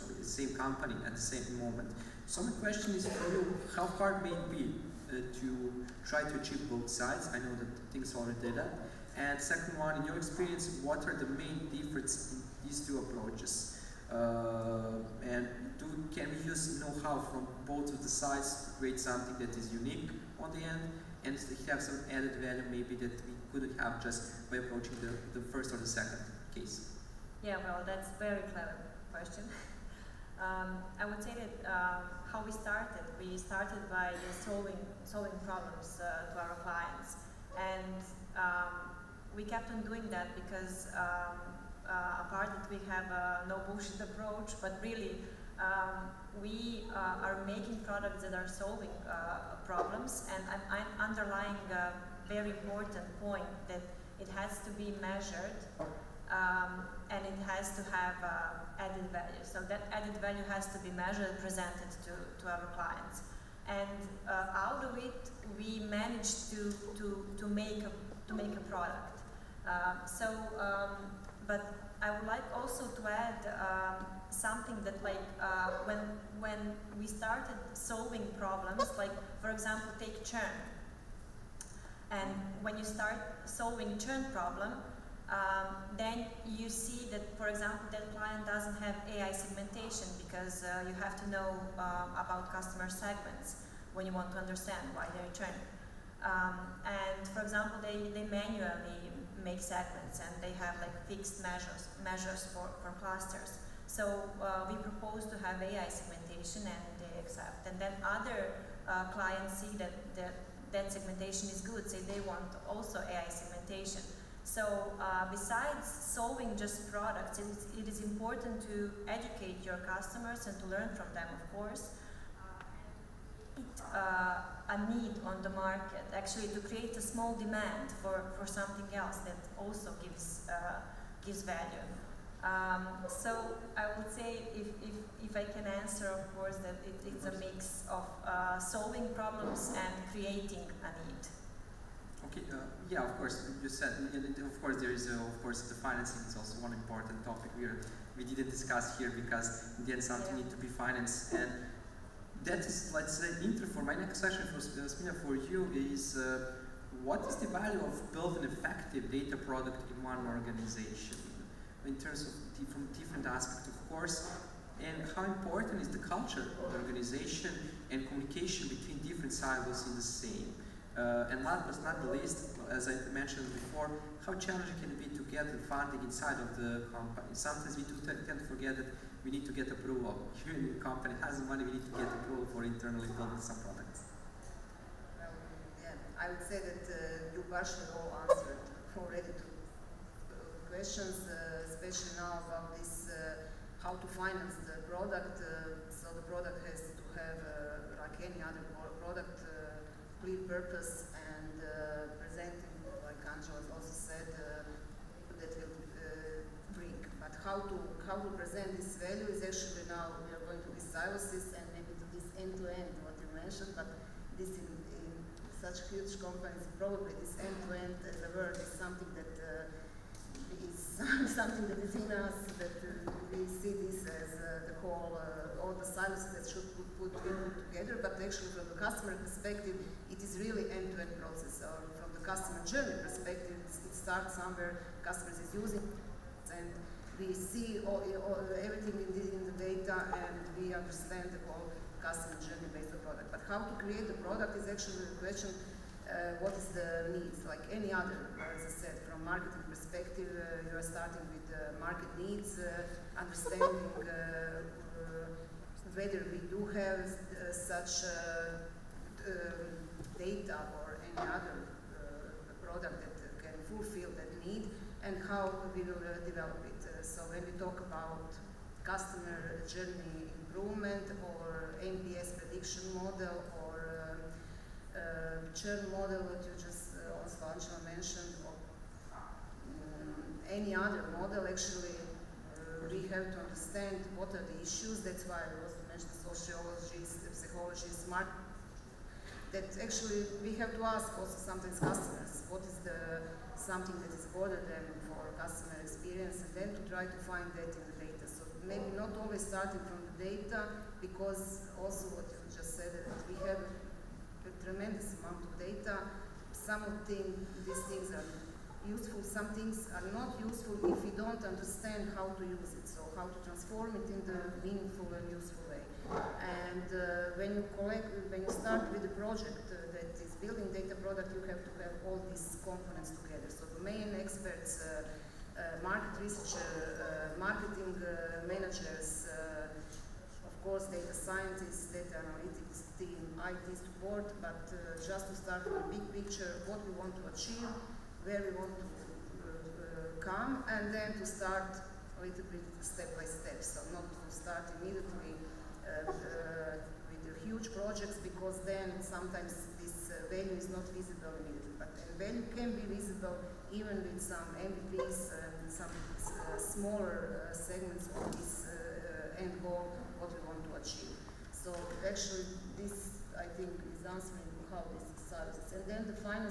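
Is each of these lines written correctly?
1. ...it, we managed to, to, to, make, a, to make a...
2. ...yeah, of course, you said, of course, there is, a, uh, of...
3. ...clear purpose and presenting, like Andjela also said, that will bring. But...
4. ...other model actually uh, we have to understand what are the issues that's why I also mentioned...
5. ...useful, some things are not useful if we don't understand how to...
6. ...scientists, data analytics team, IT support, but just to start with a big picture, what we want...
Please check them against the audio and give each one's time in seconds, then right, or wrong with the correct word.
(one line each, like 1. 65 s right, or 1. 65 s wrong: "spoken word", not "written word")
1. 64 s right
2. 142 s right
3. 200 s right
4. 280 s right
5. 308 s right
6. 331 s right.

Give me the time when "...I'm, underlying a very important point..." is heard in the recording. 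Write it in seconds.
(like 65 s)
50 s.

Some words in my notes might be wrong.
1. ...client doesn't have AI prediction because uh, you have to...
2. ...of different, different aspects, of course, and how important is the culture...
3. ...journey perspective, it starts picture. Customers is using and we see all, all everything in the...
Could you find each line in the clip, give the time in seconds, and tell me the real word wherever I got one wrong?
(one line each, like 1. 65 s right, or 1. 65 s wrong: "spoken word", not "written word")
1. 88 s wrong: "segmentation", not "prediction"
2. 162 s right
3. 232 s wrong: "somewhere", not "picture".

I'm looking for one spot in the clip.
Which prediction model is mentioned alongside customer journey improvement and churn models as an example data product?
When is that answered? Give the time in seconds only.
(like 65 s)
271 s.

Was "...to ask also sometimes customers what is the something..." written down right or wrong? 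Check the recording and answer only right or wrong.
right.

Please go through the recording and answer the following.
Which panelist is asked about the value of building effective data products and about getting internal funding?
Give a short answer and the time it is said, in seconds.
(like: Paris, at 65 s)
Smilja, at 154 s.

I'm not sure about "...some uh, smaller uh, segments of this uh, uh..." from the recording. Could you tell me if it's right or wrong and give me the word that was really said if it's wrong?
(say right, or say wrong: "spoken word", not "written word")
right.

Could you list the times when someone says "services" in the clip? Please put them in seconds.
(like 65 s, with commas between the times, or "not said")
210 s, 365 s.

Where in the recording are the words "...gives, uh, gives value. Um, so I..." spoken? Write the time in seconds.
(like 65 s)
130 s.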